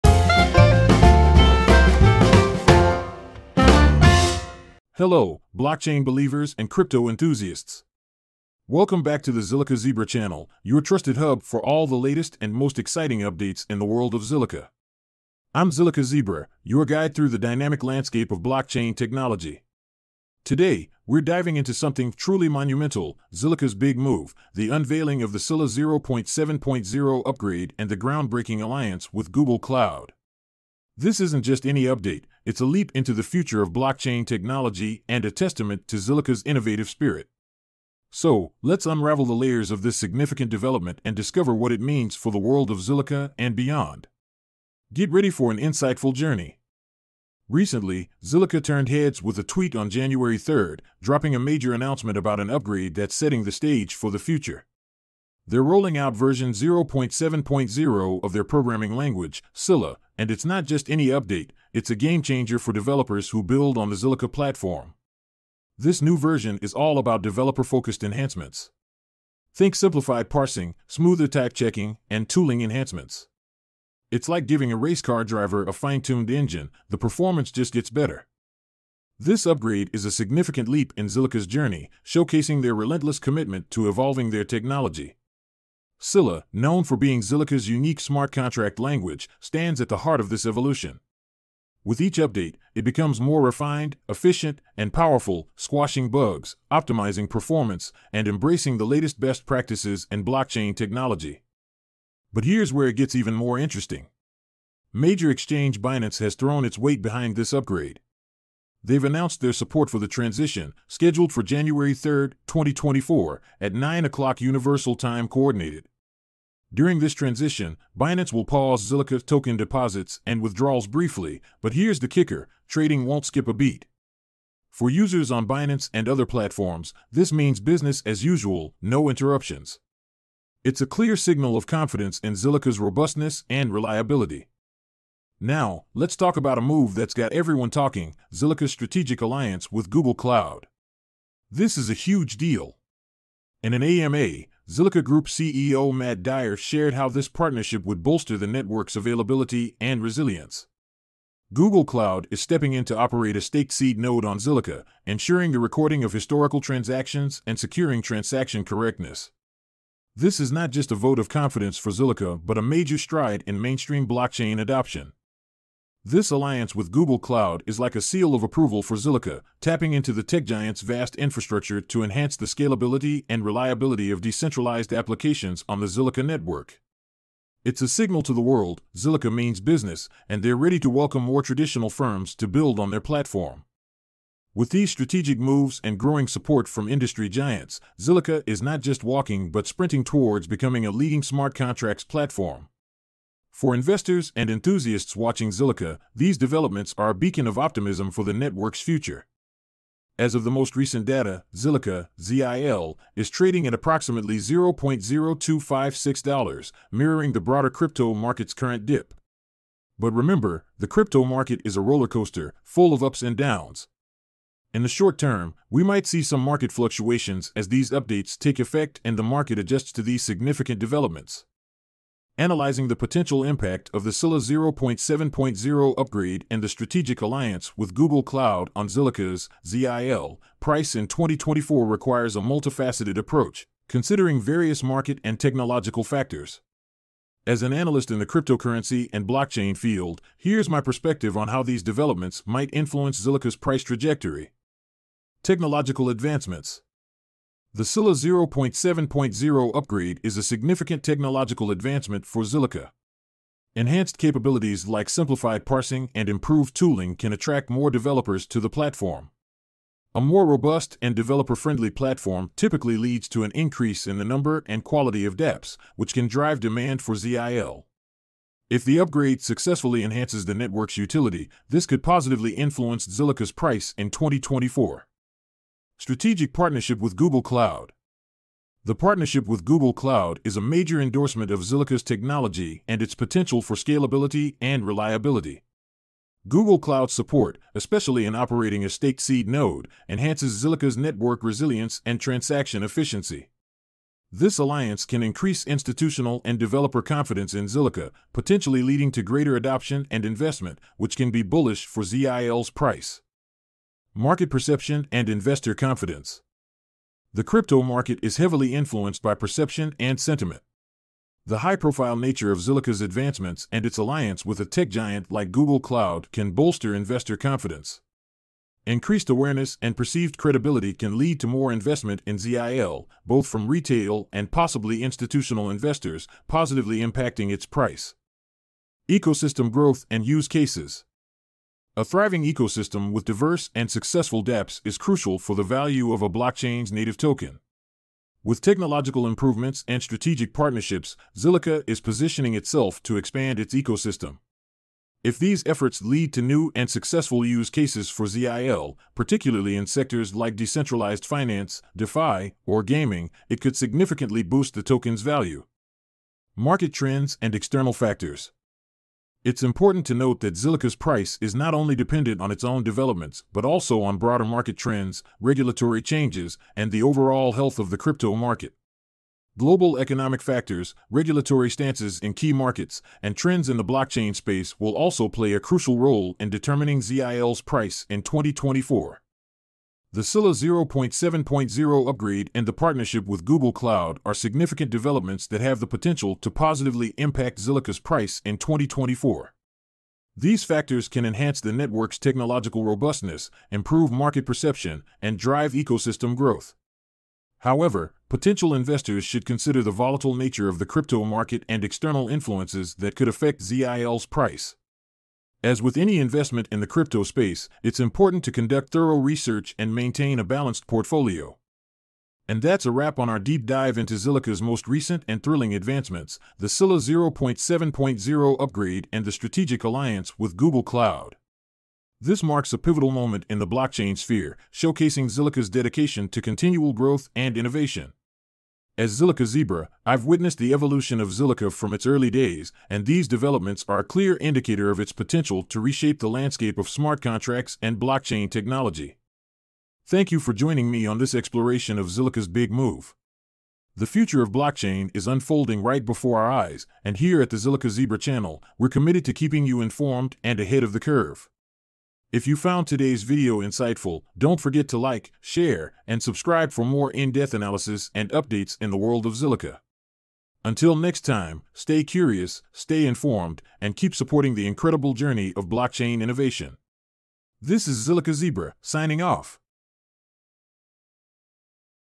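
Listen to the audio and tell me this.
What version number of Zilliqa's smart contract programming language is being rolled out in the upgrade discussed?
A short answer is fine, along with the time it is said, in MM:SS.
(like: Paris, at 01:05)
0.7.0, at 00:56.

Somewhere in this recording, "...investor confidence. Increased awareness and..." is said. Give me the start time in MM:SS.
05:16.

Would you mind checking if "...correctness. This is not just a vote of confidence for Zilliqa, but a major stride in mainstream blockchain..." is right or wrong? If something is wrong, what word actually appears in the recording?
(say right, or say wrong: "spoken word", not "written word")
right.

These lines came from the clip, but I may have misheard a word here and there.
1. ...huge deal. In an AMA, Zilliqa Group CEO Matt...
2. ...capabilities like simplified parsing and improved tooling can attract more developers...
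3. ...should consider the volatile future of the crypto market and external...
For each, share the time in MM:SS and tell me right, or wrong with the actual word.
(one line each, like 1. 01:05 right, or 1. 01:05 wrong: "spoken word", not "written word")
1. 02:21 right
2. 04:14 right
3. 06:39 wrong: "nature", not "future".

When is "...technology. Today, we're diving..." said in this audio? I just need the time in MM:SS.
00:18.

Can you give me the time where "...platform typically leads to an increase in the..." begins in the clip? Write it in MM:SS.
04:21.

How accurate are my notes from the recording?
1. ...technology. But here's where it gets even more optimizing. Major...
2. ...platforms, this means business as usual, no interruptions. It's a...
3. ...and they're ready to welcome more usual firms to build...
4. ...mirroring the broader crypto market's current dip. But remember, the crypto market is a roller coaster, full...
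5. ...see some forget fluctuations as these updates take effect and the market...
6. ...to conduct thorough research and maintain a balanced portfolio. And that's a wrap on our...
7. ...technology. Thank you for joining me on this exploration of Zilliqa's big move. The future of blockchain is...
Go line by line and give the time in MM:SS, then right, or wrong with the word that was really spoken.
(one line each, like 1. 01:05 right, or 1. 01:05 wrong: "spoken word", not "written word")
1. 01:40 wrong: "interesting", not "optimizing"
2. 02:06 right
3. 03:00 wrong: "traditional", not "usual"
4. 03:26 right
5. 03:36 wrong: "market", not "forget"
6. 06:48 right
7. 07:18 right.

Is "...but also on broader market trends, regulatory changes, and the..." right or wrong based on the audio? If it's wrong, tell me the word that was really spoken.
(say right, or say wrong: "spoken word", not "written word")
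right.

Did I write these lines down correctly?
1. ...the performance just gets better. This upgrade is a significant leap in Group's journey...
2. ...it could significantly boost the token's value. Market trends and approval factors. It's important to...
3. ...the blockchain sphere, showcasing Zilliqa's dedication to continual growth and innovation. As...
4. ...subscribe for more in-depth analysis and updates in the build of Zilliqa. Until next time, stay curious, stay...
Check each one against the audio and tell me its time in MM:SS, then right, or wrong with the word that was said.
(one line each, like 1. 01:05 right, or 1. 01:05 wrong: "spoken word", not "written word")
1. 01:16 wrong: "Zilliqa", not "Group"
2. 05:53 wrong: "external", not "approval"
3. 07:03 right
4. 07:36 wrong: "world", not "build".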